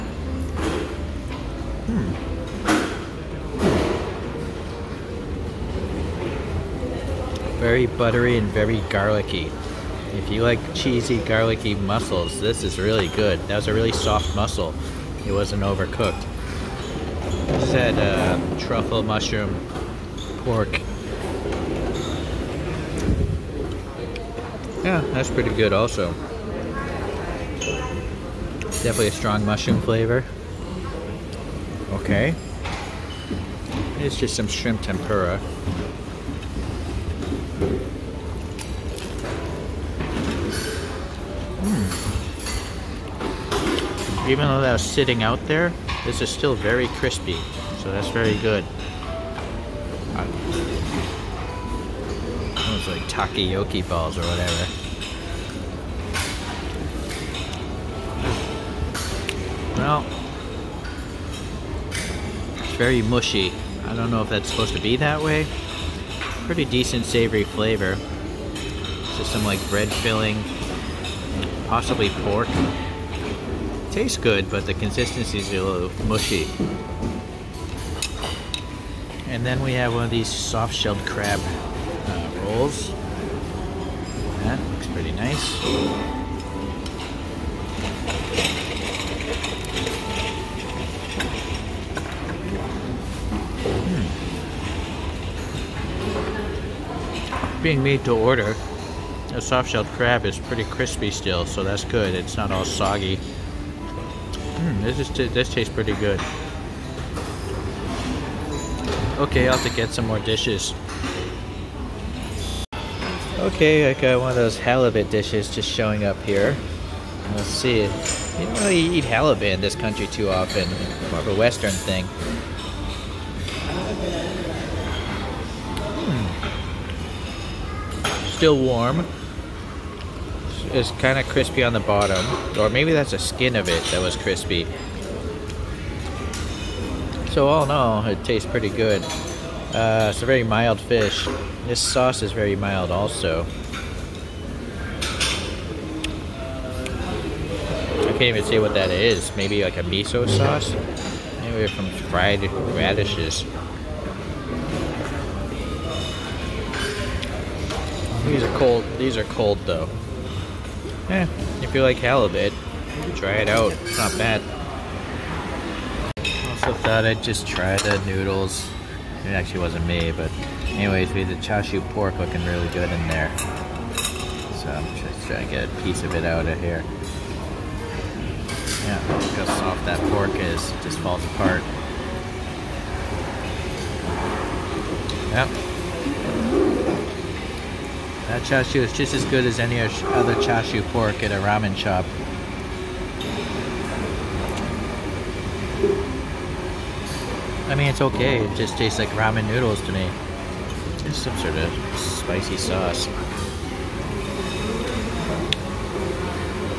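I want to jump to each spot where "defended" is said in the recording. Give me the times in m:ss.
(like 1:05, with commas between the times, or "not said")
not said.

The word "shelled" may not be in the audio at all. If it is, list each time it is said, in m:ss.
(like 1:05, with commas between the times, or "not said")
1:20, 1:39.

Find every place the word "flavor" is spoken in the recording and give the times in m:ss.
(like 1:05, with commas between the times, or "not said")
0:29, 1:07.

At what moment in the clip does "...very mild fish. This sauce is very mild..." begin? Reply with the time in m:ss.
2:20.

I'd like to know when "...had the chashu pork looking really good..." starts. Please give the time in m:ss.
2:51.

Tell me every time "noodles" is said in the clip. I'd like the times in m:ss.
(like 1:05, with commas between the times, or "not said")
2:48, 3:19.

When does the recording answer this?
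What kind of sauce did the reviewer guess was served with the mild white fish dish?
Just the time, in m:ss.
2:29.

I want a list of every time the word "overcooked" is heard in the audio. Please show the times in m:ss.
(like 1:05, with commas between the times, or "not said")
0:15.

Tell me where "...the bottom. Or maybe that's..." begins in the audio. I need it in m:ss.
2:11.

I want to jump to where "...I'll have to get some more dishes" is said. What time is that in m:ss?
1:49.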